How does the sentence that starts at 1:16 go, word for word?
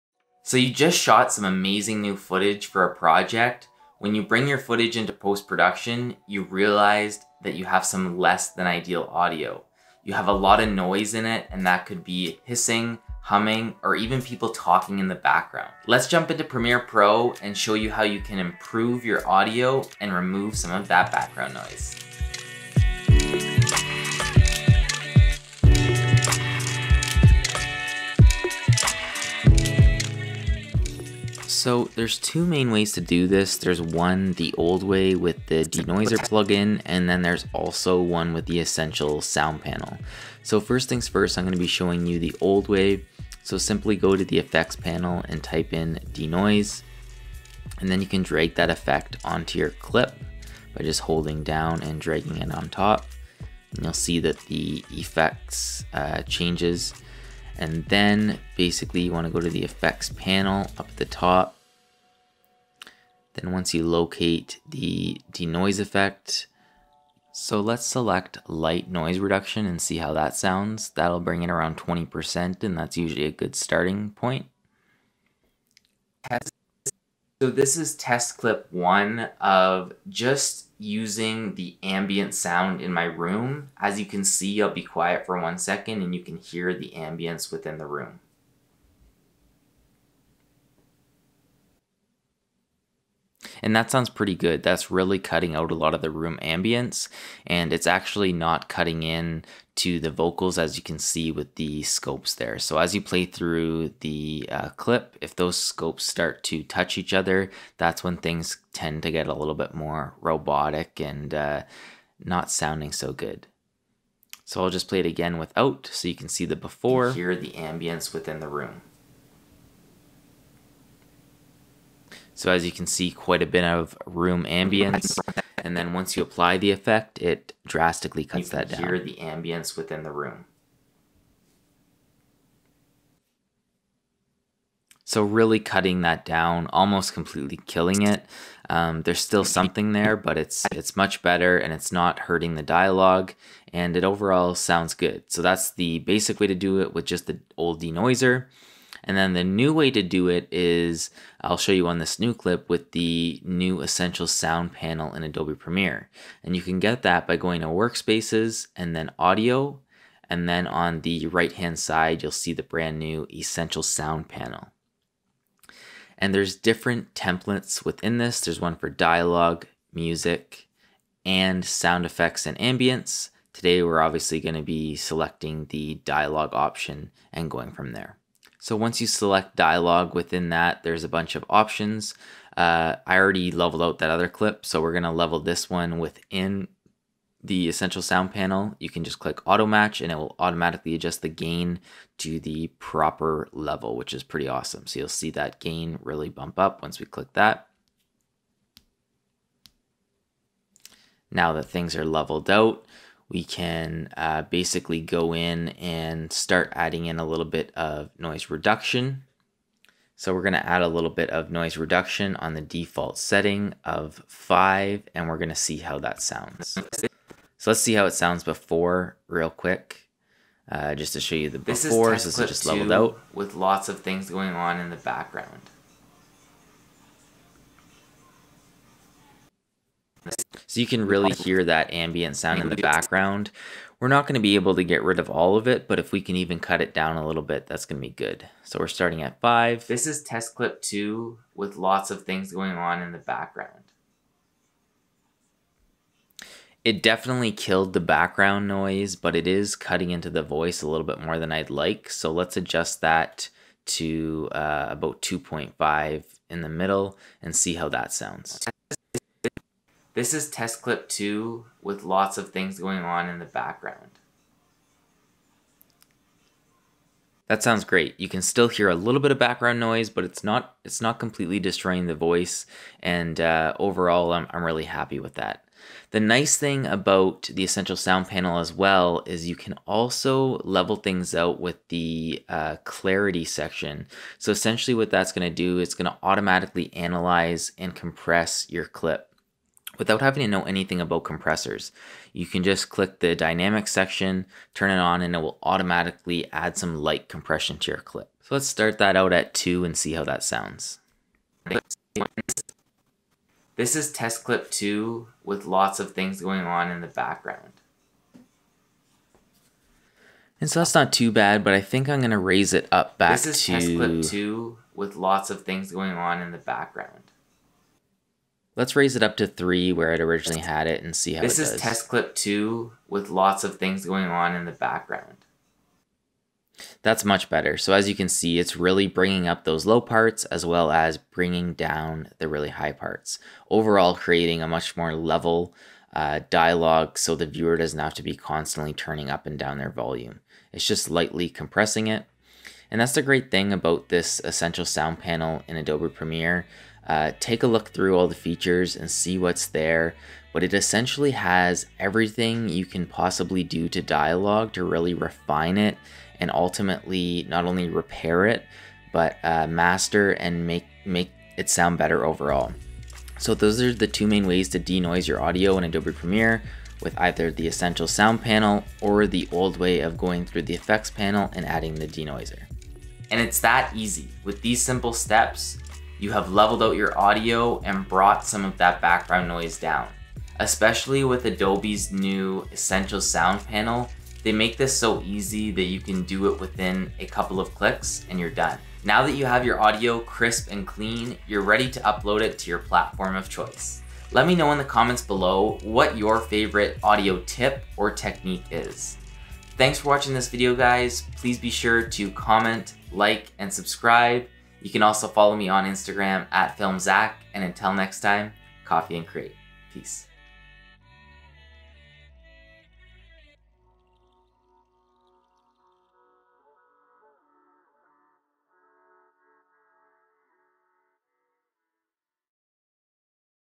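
Has so this is test clip one of just using the ambient sound in my room.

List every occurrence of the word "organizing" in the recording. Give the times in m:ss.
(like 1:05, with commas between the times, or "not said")
not said.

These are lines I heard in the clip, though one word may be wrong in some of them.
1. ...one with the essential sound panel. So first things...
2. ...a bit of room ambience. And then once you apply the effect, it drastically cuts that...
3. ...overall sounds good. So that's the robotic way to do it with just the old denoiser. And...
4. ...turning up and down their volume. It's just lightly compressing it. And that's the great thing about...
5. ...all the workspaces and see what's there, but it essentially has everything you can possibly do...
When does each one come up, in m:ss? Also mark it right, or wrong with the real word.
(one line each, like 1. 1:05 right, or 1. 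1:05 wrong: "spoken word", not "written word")
1. 0:38 right
2. 2:03 right
3. 2:24 wrong: "basic", not "robotic"
4. 5:38 right
5. 5:48 wrong: "features", not "workspaces".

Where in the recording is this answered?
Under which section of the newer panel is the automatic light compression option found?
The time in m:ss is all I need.
4:42.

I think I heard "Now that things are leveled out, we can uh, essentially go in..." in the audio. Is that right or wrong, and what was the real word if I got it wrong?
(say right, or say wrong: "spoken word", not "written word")
wrong: "basically", not "essentially".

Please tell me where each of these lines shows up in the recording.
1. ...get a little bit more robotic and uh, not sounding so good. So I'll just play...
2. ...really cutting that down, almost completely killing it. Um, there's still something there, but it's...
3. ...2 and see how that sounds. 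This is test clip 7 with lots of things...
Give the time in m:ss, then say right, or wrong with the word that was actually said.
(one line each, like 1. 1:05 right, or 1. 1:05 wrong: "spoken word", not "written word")
1. 1:49 right
2. 2:15 right
3. 4:59 wrong: "2", not "7".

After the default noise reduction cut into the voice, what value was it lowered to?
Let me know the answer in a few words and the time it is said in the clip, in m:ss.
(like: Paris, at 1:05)
2.5, at 4:15.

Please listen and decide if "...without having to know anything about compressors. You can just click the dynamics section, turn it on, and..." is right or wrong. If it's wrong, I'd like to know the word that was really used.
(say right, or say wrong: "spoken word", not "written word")
right.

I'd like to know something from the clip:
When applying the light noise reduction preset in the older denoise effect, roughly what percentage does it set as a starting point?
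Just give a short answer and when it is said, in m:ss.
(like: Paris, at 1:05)
20%, at 1:11.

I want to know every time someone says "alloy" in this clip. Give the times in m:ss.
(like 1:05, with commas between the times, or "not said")
not said.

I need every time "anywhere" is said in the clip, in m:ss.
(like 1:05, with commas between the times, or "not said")
not said.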